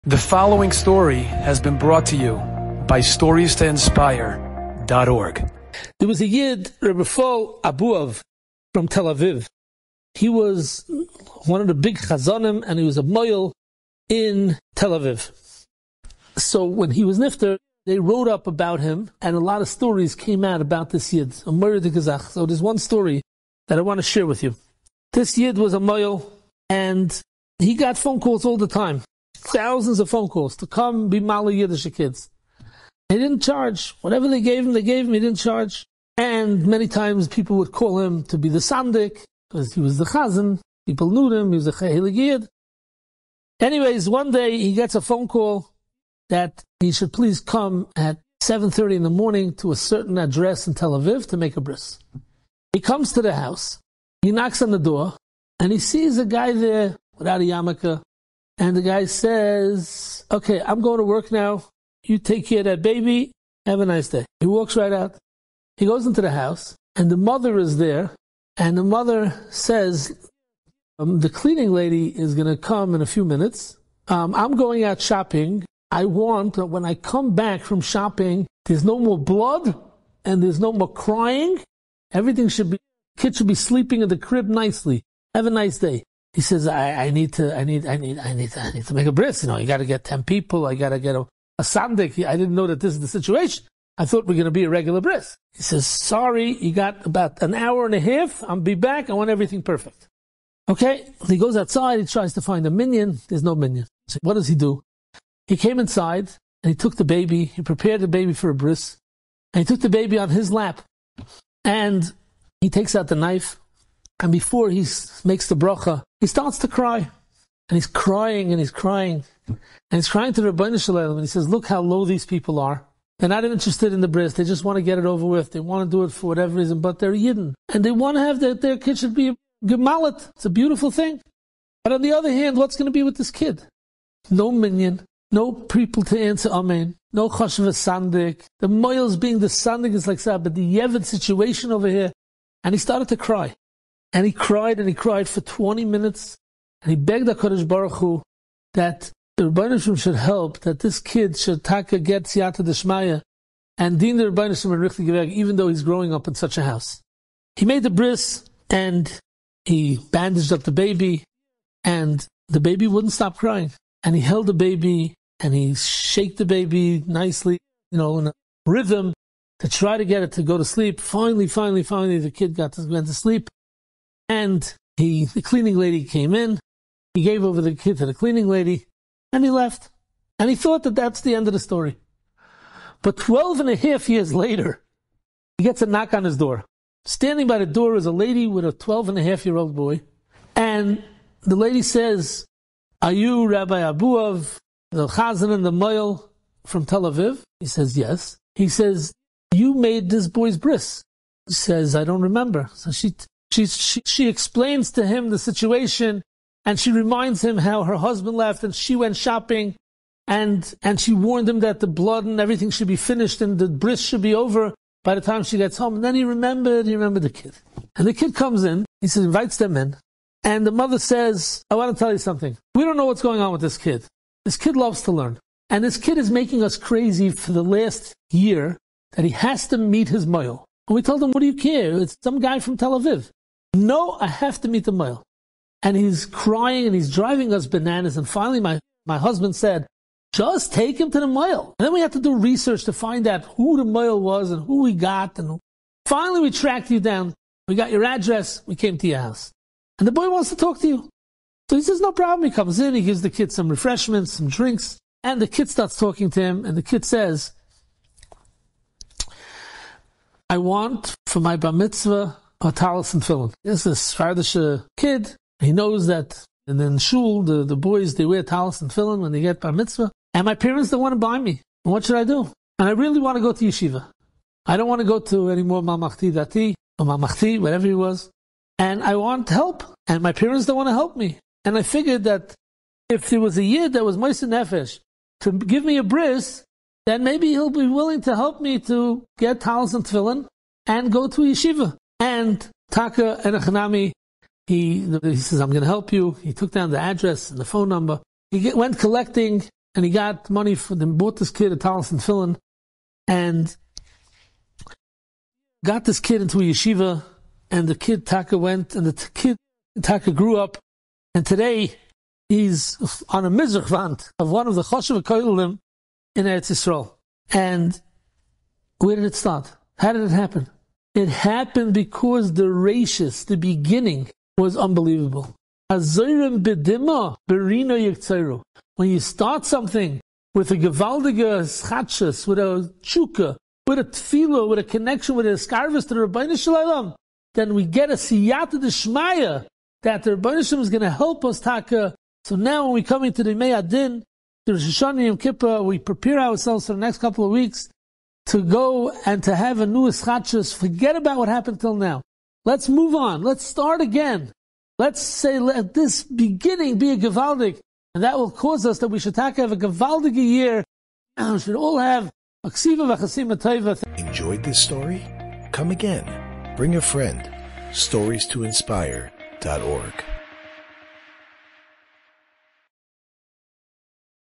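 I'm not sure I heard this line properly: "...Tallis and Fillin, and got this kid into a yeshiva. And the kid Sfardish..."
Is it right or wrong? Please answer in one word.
wrong.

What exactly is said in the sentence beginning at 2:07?
And they want to have their, their kid should be a gemalit.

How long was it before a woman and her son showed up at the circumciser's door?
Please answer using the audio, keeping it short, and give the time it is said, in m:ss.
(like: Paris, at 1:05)
12 and a half, at 3:03.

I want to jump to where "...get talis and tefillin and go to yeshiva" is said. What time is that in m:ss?
4:49.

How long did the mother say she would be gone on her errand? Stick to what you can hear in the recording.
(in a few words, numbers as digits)
About an hour and a half.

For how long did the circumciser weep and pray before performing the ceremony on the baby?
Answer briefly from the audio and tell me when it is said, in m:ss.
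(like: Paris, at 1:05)
20 minutes, at 2:25.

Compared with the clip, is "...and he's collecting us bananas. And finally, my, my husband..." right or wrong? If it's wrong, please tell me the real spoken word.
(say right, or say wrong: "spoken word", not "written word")
wrong: "driving", not "collecting".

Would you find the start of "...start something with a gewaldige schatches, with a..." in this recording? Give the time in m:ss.
5:29.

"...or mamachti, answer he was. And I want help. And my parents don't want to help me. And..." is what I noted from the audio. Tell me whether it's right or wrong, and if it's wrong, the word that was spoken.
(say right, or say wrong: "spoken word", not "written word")
wrong: "whatever", not "answer".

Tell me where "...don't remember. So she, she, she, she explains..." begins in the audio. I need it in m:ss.
3:22.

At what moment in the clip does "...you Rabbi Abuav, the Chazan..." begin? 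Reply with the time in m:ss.
3:13.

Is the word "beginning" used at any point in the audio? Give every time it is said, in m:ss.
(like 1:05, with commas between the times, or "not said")
5:23, 5:56.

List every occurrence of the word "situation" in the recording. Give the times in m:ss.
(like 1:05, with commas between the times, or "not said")
1:33, 2:21, 3:25.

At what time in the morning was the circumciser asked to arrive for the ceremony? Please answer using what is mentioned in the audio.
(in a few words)
7:30.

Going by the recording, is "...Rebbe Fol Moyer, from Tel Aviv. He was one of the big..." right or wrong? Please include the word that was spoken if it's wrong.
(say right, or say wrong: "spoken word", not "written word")
wrong: "Abuav", not "Moyer".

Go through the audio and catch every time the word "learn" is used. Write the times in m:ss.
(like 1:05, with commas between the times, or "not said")
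3:45.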